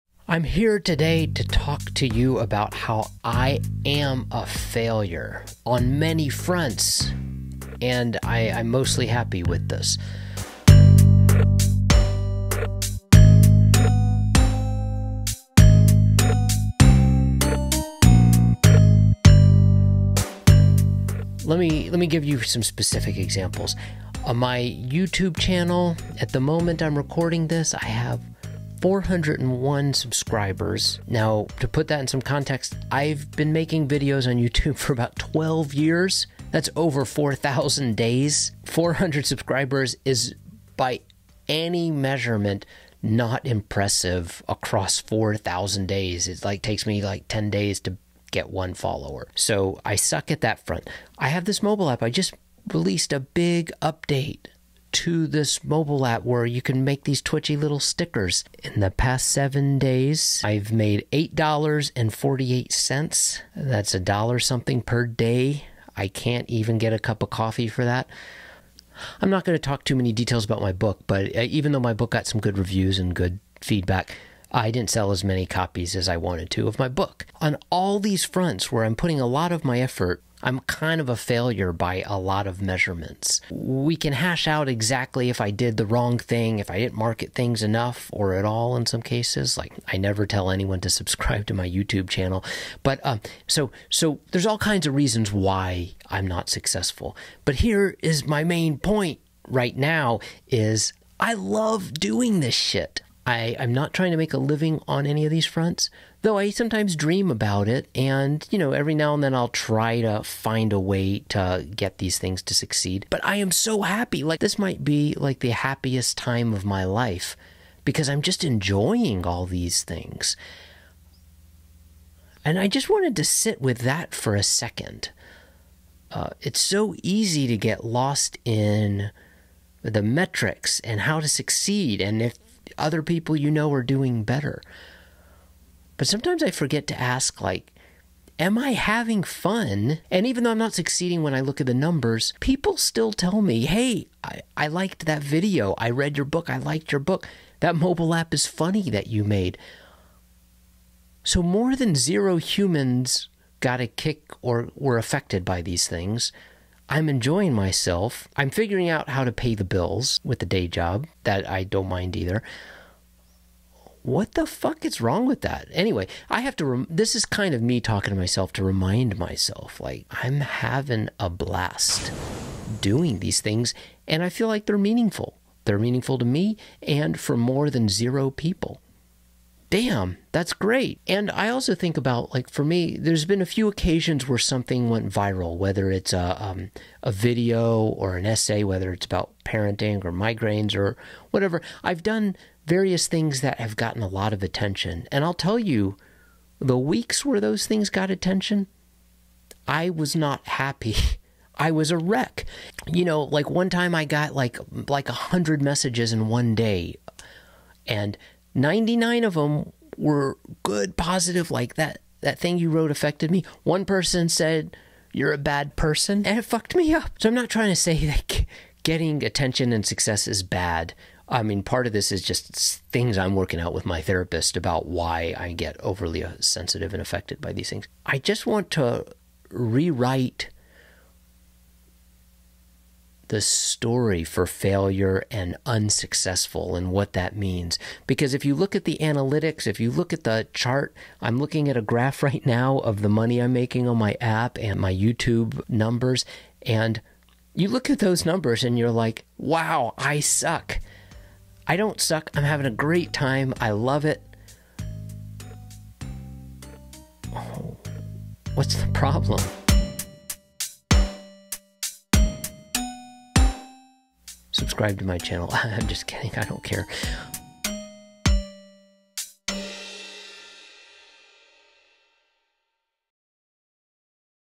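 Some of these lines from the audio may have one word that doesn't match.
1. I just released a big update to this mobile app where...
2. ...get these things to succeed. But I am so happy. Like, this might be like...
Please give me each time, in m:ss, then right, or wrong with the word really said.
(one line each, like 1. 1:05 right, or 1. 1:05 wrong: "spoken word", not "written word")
1. 0:52 right
2. 1:51 right.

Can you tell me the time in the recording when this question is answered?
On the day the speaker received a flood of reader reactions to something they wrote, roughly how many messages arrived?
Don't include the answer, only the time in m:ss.
3:25.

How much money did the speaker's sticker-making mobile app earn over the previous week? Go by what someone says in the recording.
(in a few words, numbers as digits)
$8.48.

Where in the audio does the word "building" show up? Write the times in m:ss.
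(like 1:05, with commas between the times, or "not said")
not said.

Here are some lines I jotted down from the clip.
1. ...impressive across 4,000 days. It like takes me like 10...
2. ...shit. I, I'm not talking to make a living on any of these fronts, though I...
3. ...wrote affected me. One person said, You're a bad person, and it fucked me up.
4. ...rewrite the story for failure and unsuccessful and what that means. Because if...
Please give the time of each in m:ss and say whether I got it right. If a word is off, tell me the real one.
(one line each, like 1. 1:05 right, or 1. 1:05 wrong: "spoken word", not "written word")
1. 0:43 right
2. 1:42 wrong: "trying", not "talking"
3. 3:32 right
4. 3:49 right.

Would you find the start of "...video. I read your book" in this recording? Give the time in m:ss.
2:25.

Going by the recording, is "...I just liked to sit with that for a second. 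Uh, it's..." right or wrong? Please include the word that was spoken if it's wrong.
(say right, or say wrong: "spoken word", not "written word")
wrong: "wanted", not "liked".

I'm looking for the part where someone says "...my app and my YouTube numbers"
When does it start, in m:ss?
4:03.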